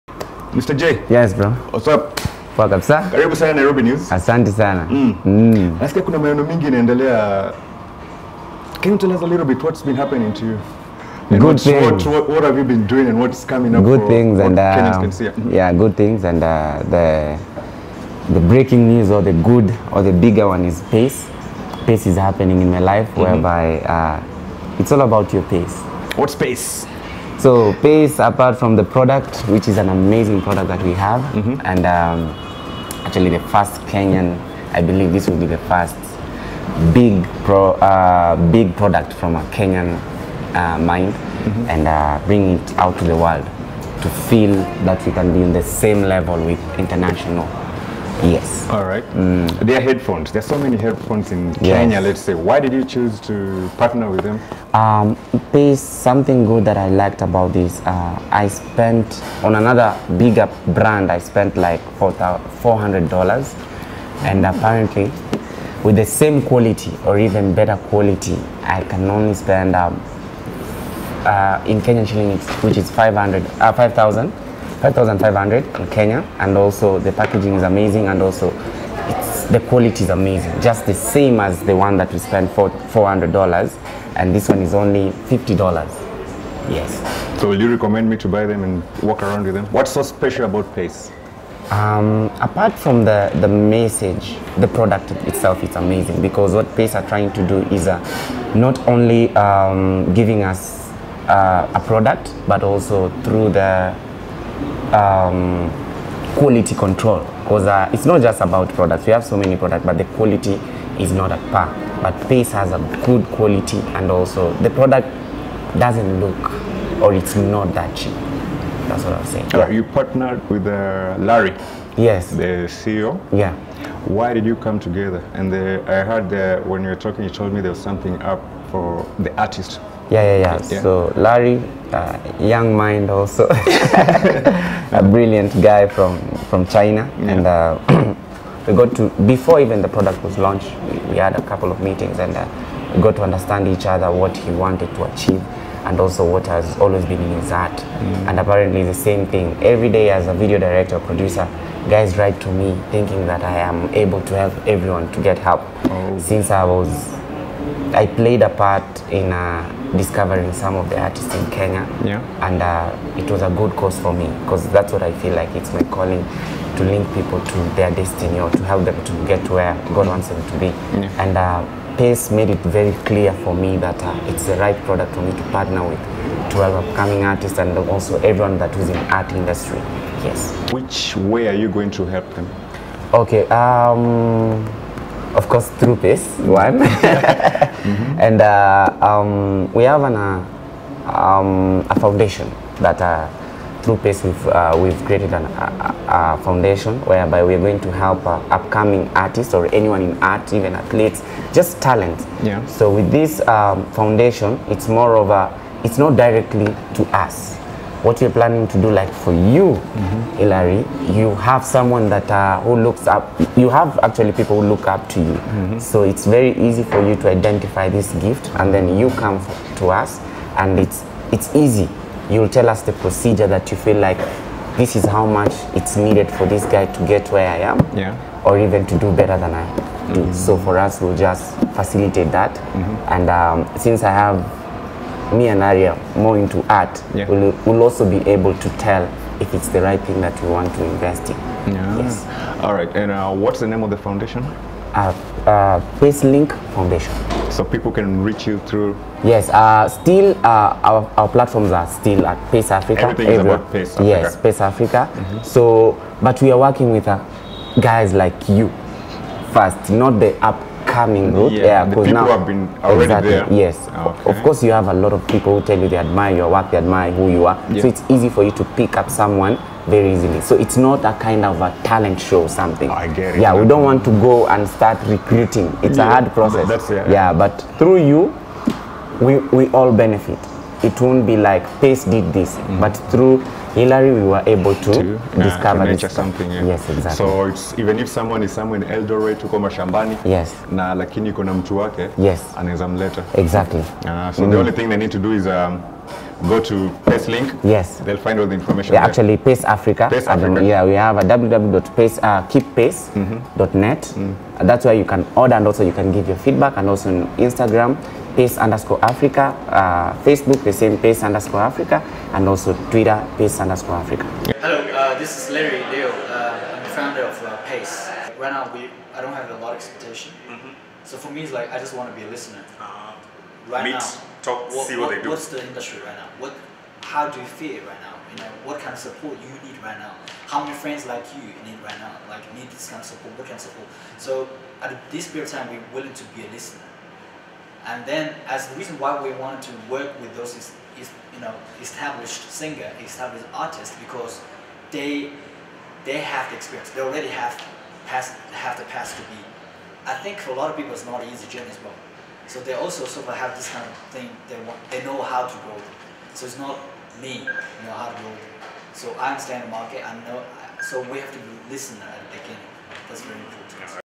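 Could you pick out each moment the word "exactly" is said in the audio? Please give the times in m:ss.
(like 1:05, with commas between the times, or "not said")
4:23, 4:46, 4:53.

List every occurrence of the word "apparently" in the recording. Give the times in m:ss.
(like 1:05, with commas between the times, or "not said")
1:04, 2:28.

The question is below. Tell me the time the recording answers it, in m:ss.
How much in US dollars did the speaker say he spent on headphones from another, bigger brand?
1:01.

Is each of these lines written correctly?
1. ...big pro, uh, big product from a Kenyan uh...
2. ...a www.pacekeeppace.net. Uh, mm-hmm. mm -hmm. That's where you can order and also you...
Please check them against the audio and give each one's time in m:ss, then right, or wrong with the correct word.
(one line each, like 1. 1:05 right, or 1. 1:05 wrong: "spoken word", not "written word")
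1. 0:36 right
2. 5:01 right.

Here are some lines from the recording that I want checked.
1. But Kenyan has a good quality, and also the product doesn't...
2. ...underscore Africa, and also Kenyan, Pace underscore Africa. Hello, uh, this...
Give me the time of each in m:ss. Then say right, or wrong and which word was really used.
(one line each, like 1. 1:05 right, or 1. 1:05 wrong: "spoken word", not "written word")
1. 1:52 wrong: "Pace", not "Kenyan"
2. 5:11 wrong: "Twitter", not "Kenyan".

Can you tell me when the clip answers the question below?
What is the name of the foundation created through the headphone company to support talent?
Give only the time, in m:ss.
4:06.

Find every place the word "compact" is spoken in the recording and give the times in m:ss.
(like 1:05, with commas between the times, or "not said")
not said.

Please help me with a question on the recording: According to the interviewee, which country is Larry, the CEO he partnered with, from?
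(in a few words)
China.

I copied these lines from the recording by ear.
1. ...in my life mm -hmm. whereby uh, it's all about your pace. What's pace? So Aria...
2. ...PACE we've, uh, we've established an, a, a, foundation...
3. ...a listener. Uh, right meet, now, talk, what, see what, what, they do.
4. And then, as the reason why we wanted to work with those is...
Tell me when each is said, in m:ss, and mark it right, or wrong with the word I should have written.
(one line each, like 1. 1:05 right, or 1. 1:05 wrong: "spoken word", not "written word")
1. 0:22 wrong: "Pace", not "Aria"
2. 3:14 wrong: "created", not "established"
3. 5:22 right
4. 5:37 right.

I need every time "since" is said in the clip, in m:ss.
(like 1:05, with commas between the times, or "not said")
2:36, 3:53.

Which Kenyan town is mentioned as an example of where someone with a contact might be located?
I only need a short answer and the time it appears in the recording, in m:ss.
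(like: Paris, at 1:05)
Eldoret, at 4:48.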